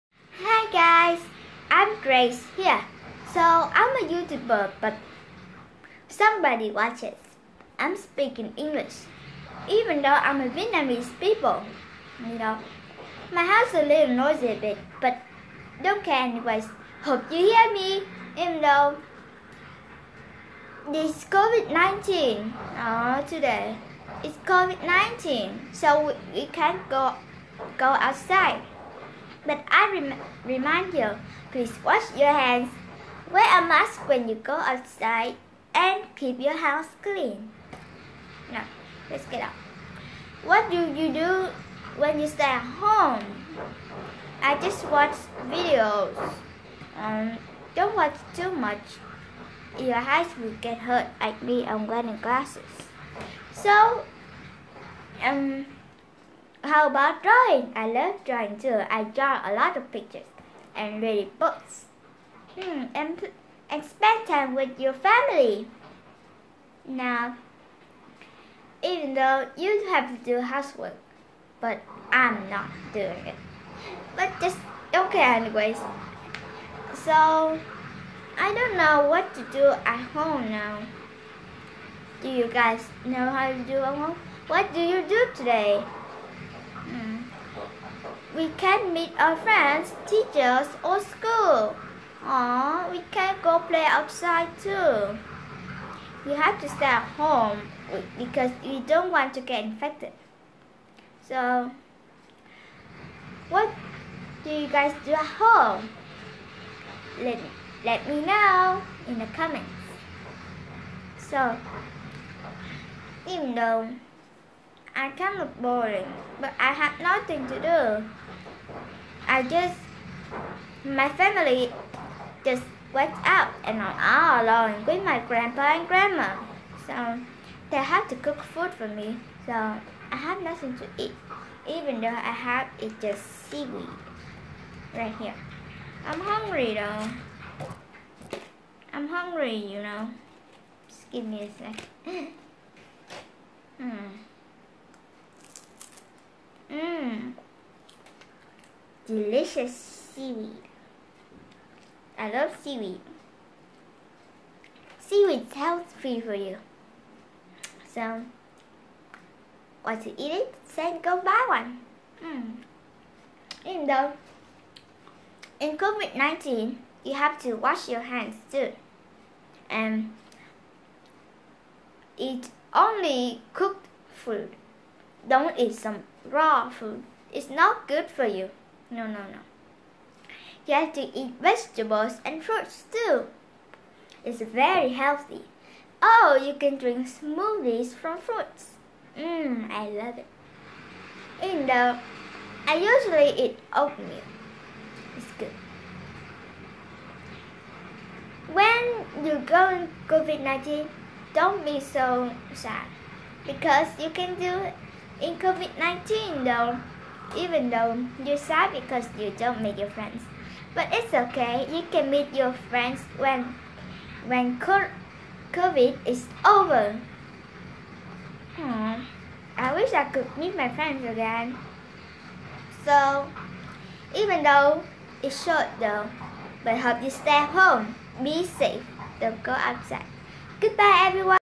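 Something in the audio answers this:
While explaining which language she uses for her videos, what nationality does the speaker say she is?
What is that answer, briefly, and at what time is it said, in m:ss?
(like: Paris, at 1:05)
Vietnamese, at 0:10.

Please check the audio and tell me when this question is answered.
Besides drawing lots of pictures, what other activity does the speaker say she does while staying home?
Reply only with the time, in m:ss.
1:01.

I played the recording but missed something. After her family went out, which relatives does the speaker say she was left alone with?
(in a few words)
Grandpa and grandma.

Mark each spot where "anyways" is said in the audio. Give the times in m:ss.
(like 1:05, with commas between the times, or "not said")
0:16, 1:15.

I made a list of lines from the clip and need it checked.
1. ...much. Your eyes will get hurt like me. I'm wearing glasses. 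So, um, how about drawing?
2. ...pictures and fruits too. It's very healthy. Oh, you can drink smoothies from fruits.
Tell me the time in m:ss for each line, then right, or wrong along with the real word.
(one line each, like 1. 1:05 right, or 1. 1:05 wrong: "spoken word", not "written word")
1. 0:48 right
2. 3:01 wrong: "vegetables", not "pictures".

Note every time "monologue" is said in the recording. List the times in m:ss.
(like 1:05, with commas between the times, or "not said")
not said.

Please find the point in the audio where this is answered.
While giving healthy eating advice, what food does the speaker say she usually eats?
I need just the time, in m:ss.
3:13.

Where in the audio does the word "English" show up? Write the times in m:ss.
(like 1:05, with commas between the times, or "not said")
0:08.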